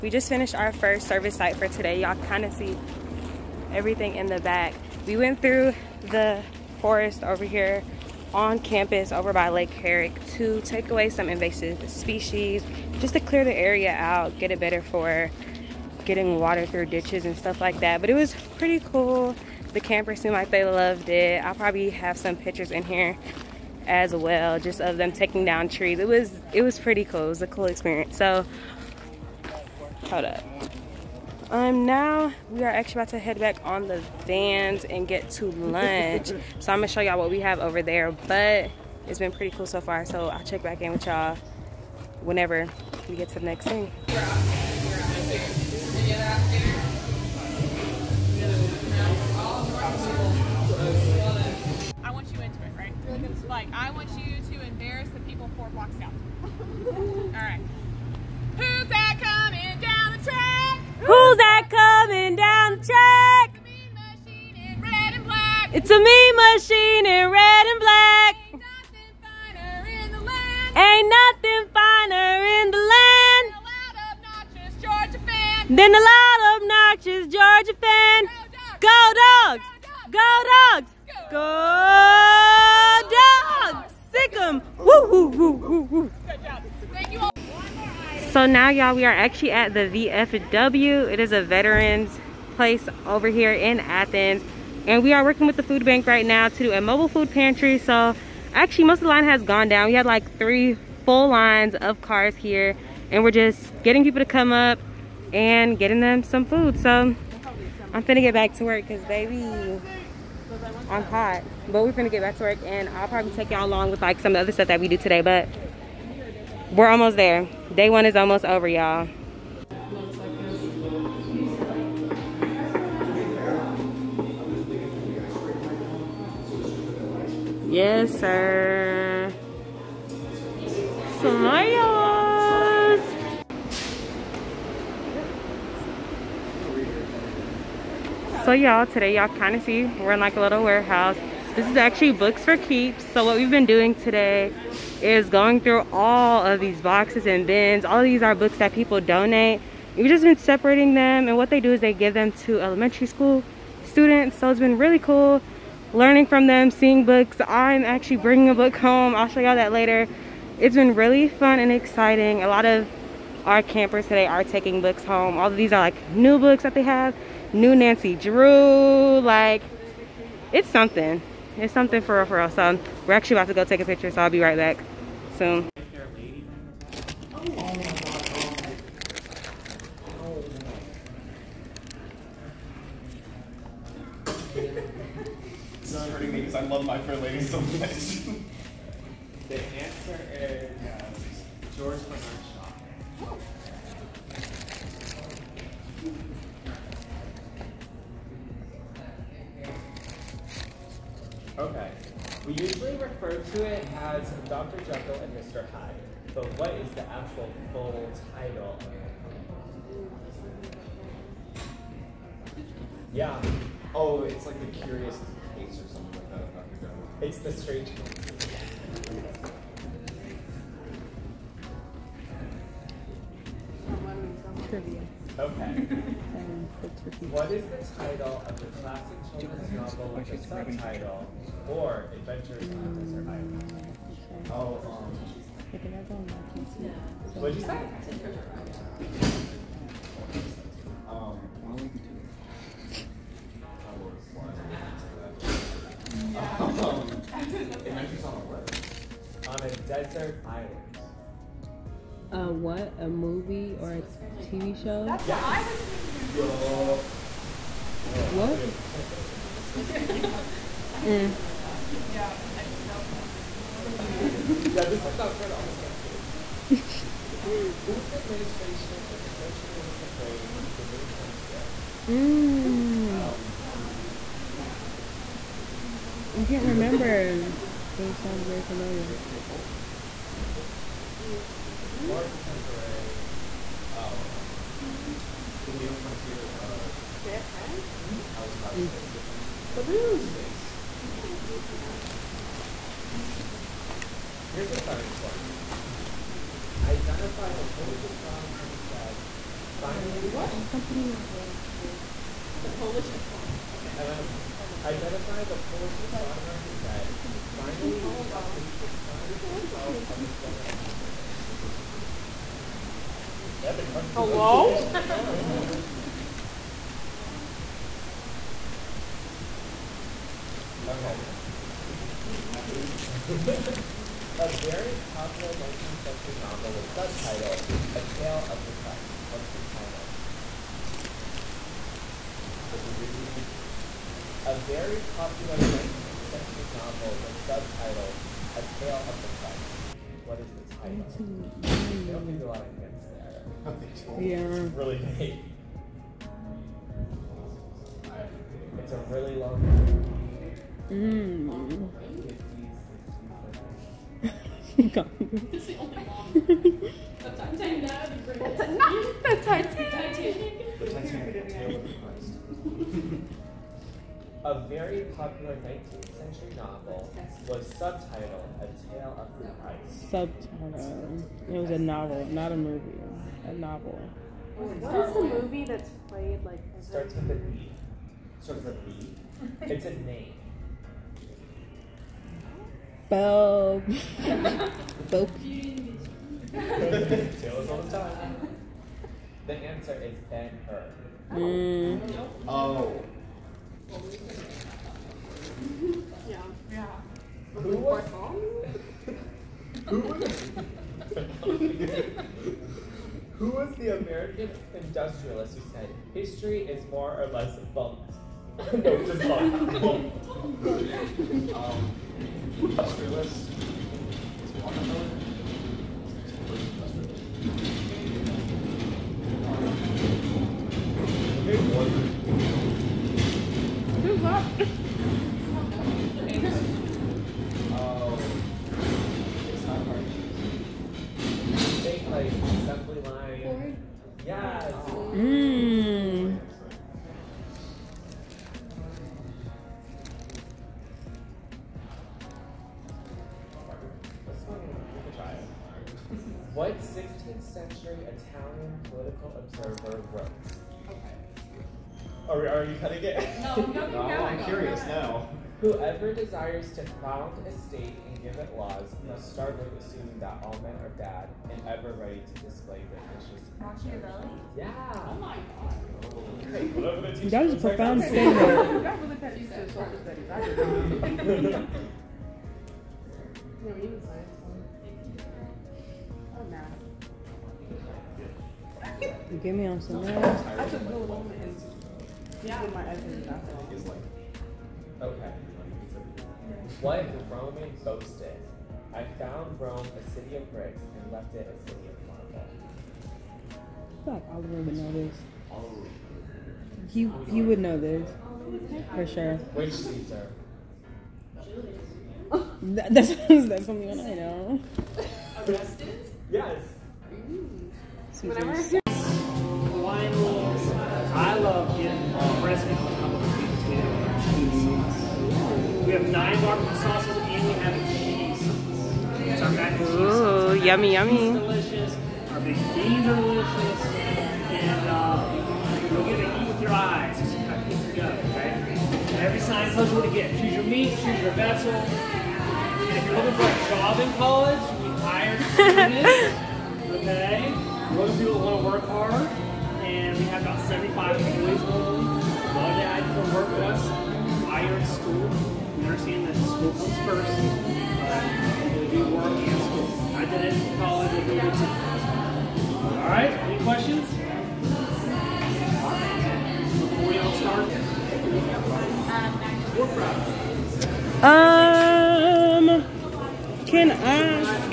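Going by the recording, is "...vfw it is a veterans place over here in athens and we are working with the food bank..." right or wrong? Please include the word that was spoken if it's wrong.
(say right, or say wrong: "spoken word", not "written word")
right.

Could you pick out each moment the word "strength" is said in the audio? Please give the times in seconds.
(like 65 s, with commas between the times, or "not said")
not said.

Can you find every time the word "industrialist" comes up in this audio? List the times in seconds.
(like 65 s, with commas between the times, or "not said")
404 s, 412 s.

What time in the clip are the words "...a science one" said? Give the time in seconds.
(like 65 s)
294 s.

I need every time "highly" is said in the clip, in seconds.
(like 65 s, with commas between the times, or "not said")
not said.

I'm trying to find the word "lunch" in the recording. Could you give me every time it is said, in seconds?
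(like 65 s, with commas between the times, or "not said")
35 s.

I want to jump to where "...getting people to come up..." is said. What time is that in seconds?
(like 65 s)
103 s.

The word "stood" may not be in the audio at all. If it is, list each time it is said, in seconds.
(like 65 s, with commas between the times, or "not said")
not said.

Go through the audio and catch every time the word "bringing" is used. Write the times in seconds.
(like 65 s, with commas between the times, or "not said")
158 s.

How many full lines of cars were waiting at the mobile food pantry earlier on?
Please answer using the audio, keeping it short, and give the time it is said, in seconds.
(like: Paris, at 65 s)
3, at 100 s.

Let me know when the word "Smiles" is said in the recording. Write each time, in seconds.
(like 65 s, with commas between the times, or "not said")
131 s.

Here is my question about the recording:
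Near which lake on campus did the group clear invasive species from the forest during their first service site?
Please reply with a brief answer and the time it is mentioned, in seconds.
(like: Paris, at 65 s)
Lake Herrick, at 9 s.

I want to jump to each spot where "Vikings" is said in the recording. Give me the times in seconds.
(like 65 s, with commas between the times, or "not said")
not said.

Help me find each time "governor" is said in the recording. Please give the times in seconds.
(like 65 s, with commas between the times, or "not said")
not said.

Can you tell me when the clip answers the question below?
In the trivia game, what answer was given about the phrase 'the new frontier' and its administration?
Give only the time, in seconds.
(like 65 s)
287 s.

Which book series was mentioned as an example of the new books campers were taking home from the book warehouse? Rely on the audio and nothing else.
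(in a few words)
Nancy Drew.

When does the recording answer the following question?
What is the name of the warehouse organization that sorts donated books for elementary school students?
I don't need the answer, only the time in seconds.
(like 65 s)
142 s.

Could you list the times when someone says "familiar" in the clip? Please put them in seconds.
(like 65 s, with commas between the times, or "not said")
278 s.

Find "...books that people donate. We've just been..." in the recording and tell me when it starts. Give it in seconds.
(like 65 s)
148 s.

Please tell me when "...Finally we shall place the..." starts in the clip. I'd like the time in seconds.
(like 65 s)
307 s.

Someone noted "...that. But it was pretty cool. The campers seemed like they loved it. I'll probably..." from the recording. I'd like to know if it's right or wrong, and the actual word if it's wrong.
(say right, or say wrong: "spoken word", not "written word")
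right.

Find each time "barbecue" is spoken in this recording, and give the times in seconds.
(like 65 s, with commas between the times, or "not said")
516 s.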